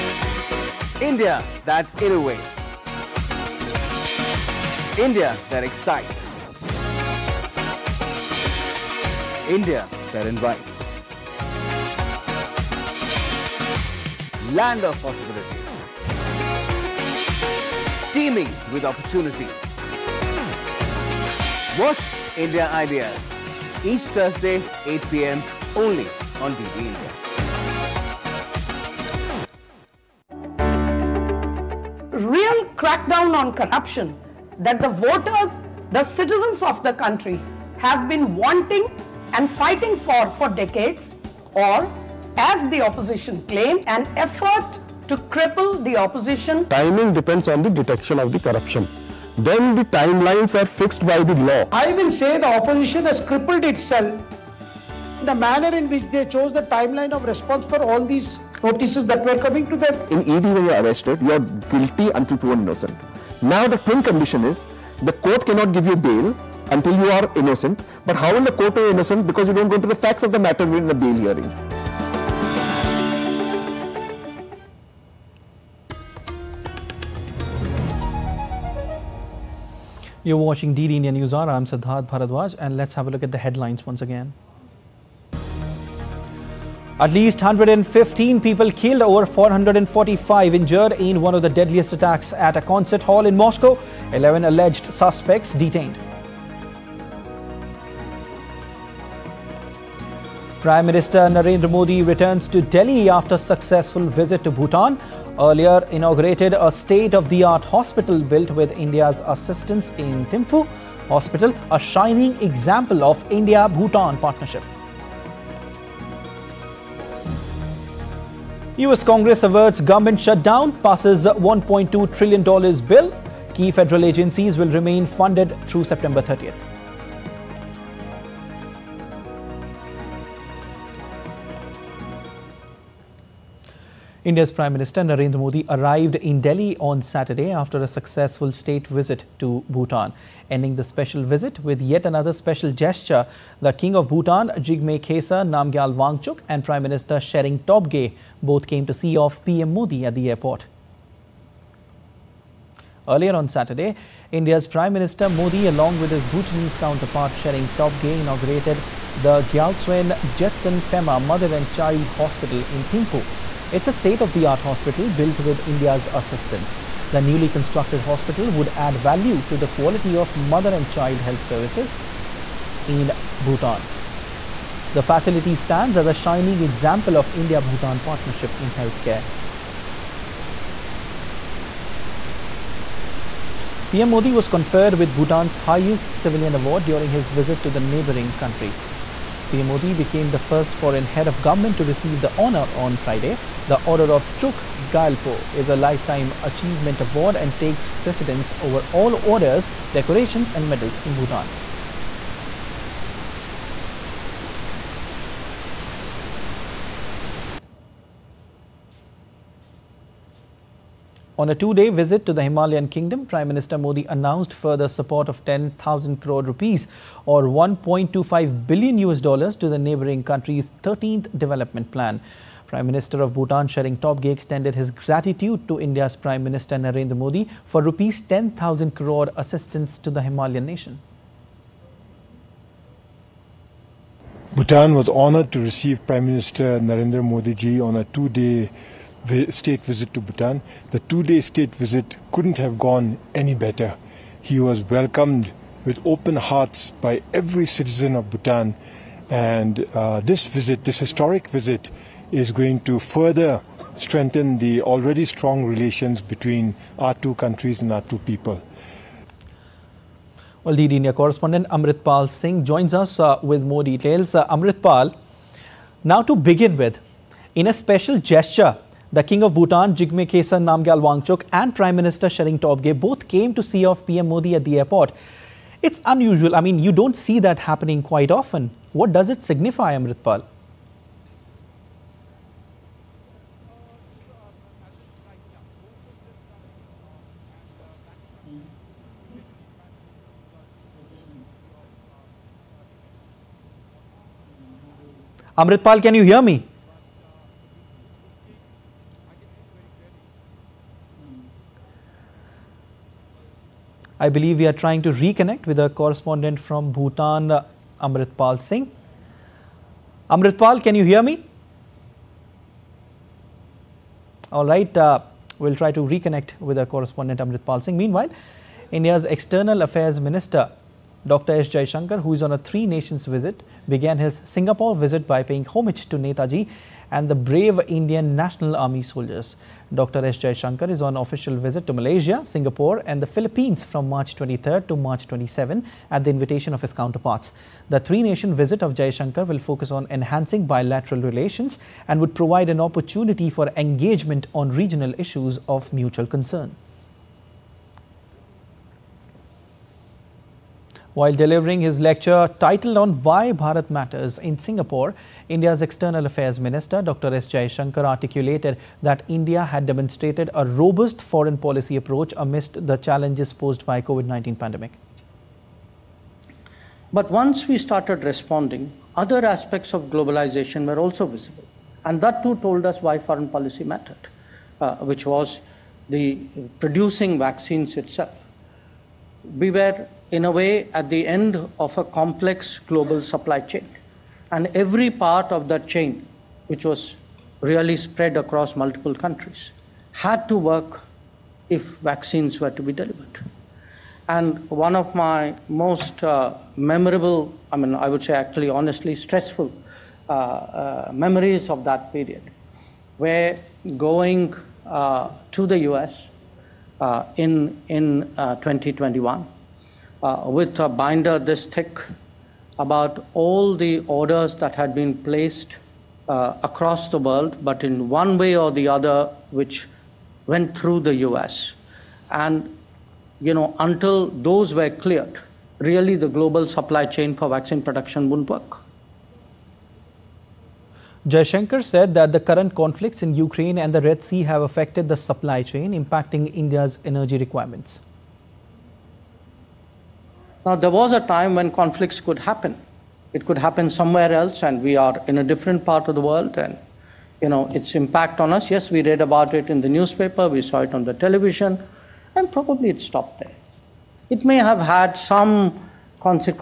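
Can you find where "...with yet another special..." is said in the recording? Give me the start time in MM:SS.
02:21.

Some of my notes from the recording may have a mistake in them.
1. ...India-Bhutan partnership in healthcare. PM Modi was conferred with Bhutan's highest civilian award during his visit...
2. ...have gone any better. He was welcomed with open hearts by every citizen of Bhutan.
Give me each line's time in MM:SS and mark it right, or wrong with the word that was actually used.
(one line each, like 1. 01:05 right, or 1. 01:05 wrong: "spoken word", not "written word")
1. 02:57 right
2. 04:02 right.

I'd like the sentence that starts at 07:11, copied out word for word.
Jaishankar said that the current conflicts in Ukraine and the Red Sea have affected the supply chain, impacting India's energy requirements.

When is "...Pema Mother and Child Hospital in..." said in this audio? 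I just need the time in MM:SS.
02:40.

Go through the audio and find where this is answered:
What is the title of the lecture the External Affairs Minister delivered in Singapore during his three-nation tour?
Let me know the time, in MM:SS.
05:53.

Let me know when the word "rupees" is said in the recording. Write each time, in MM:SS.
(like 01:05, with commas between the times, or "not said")
03:36, 03:47.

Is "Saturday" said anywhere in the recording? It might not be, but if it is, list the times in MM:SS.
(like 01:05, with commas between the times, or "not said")
02:17, 02:33.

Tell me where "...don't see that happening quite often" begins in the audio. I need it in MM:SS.
04:36.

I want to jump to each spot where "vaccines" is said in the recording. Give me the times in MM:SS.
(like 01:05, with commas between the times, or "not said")
06:17, 06:31, 07:07.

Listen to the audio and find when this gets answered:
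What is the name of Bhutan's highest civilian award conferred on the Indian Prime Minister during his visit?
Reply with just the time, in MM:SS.
03:13.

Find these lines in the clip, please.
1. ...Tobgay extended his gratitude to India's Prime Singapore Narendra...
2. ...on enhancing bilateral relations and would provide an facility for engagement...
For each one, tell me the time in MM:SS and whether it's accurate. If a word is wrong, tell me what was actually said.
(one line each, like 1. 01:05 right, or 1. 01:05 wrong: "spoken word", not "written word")
1. 03:44 wrong: "Minister", not "Singapore"
2. 05:39 wrong: "opportunity", not "facility".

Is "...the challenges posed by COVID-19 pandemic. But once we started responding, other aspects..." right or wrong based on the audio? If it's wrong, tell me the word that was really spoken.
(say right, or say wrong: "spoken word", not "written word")
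right.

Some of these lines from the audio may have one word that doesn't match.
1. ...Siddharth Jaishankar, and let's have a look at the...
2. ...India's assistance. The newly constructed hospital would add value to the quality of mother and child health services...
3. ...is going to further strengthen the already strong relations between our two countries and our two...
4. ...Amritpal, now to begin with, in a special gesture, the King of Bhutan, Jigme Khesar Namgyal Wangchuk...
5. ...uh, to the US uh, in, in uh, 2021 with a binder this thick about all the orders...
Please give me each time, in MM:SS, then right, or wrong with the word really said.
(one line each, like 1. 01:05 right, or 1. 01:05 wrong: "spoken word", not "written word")
1. 01:21 wrong: "Bharadwaj", not "Jaishankar"
2. 02:45 right
3. 04:12 right
4. 04:24 right
5. 06:44 right.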